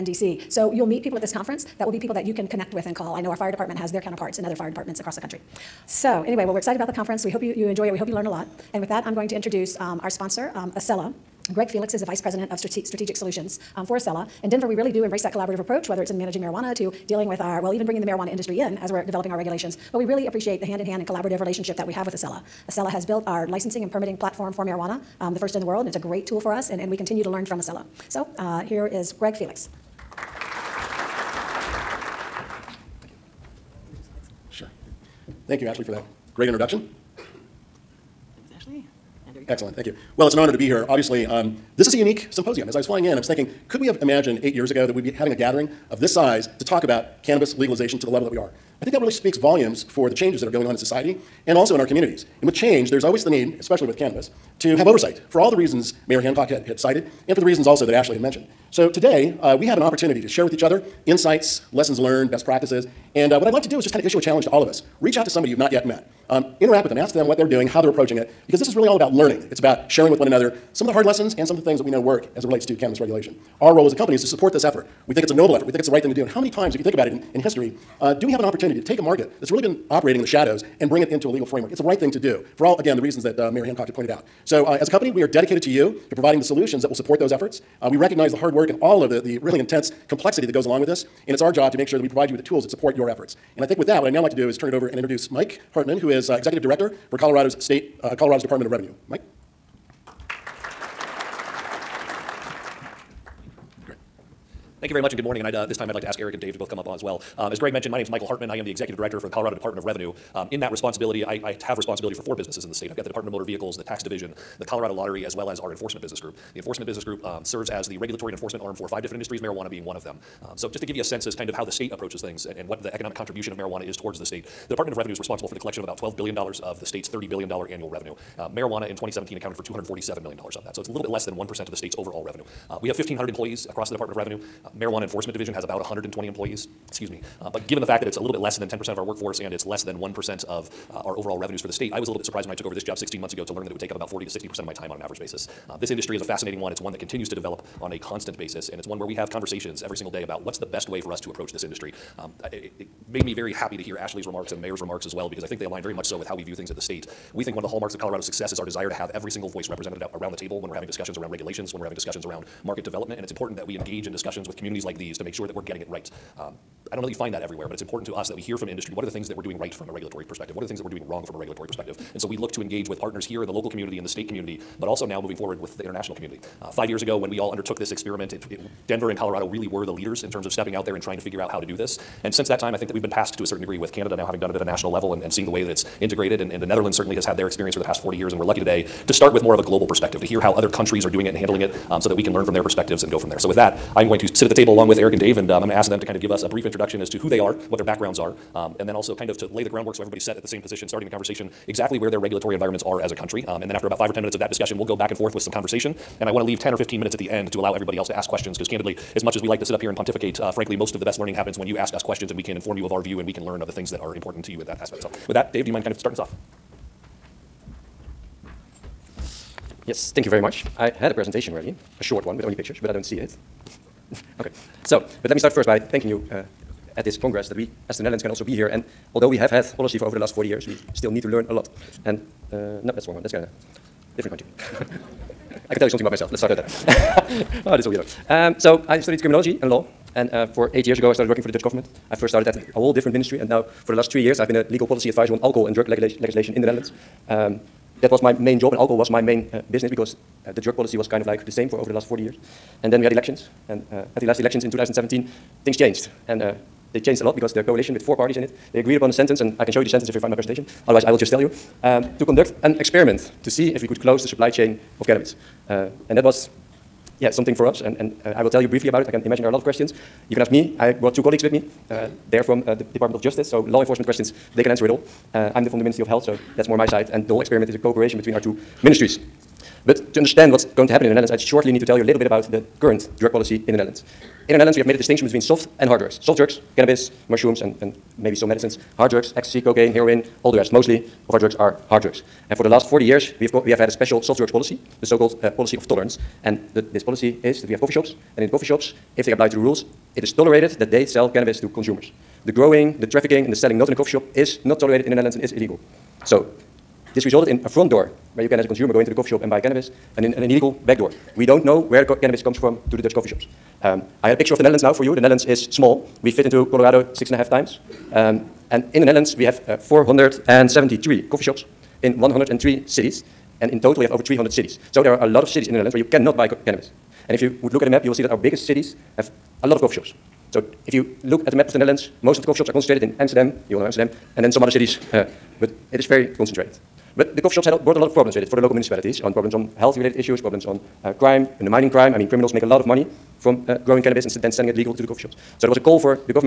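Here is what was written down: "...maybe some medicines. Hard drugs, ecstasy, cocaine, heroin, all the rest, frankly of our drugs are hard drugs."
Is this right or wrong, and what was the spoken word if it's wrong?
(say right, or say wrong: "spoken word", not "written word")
wrong: "mostly", not "frankly".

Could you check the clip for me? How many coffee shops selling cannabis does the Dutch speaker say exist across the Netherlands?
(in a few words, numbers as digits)
473.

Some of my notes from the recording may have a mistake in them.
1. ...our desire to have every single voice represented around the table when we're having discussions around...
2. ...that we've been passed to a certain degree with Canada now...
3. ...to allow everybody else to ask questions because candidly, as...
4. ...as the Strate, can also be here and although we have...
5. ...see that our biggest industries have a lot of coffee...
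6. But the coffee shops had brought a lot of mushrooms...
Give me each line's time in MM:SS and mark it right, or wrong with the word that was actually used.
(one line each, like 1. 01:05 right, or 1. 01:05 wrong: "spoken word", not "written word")
1. 02:38 right
2. 03:02 right
3. 03:27 right
4. 03:47 wrong: "Netherlands", not "Strate"
5. 05:28 wrong: "cities", not "industries"
6. 05:37 wrong: "problems", not "mushrooms".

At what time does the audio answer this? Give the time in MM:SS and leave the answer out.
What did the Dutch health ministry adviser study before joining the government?
03:59.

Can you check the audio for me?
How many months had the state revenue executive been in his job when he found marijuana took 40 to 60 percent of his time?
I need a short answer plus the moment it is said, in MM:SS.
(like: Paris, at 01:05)
16, at 02:22.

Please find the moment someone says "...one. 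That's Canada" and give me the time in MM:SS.
03:53.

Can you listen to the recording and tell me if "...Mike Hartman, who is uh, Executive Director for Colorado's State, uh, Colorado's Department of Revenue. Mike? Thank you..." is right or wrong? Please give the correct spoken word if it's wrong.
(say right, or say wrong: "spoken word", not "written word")
right.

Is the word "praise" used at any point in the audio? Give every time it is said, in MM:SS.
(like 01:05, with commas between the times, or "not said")
not said.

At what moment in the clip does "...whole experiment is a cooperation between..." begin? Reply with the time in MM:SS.
04:37.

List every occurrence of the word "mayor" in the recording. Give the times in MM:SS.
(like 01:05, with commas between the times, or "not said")
00:56, 01:23, 02:34.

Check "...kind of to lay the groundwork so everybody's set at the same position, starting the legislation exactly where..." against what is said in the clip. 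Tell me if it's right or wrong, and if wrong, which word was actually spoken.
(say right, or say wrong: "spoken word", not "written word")
wrong: "conversation", not "legislation".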